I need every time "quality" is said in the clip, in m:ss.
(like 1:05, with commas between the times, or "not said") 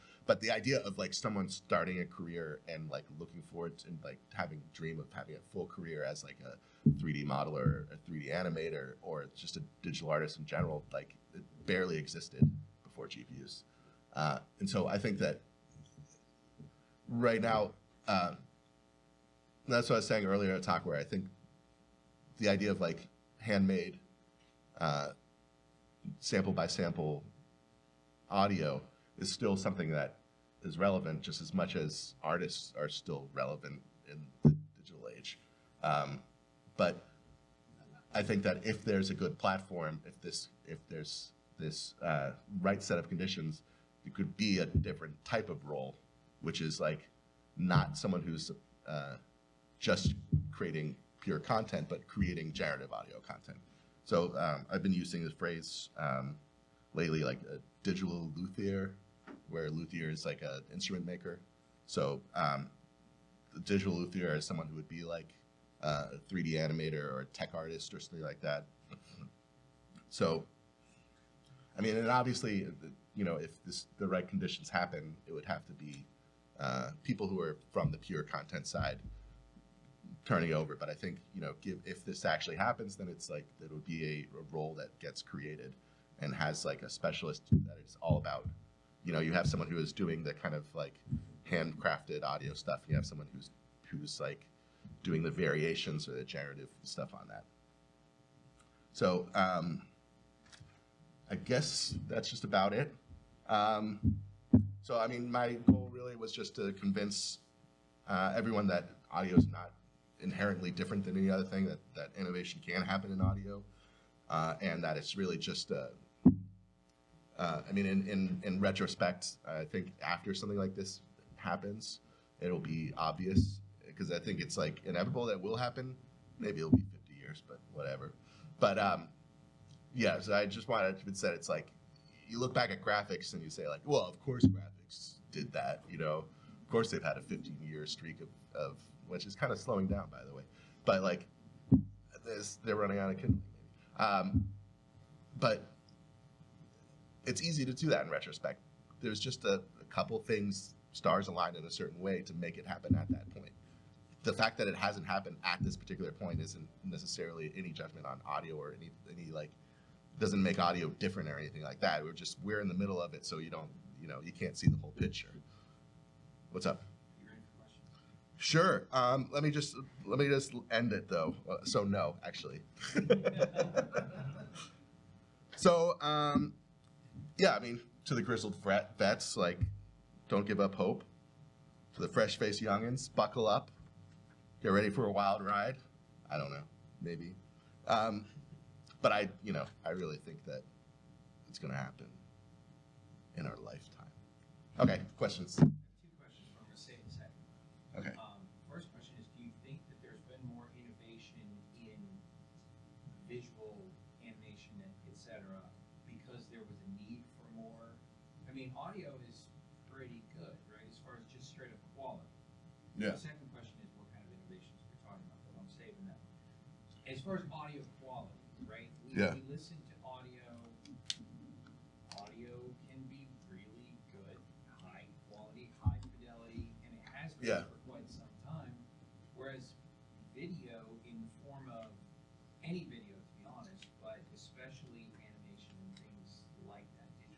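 3:37, 3:45.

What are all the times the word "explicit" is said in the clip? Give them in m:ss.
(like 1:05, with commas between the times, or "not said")
not said.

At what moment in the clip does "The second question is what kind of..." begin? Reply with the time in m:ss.
3:33.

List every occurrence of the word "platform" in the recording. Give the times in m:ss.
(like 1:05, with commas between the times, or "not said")
0:39.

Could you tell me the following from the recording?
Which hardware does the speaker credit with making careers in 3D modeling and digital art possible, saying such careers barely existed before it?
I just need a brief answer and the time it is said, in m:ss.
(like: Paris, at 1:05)
GPUs, at 0:13.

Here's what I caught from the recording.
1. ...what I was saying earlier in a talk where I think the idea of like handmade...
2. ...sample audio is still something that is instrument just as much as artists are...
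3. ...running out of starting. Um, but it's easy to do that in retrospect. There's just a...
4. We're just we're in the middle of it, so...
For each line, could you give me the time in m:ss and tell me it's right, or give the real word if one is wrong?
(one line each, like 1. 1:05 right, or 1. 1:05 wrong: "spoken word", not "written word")
1. 0:19 right
2. 0:26 wrong: "relevant", not "instrument"
3. 2:22 wrong: "kindling", not "starting"
4. 2:42 right.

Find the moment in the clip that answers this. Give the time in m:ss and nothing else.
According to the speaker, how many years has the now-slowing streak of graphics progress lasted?
2:17.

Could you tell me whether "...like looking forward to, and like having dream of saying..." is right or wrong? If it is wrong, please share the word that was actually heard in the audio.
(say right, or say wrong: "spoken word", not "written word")
wrong: "having", not "saying".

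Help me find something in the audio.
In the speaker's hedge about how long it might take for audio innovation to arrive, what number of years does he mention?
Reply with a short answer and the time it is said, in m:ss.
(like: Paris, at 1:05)
50, at 2:06.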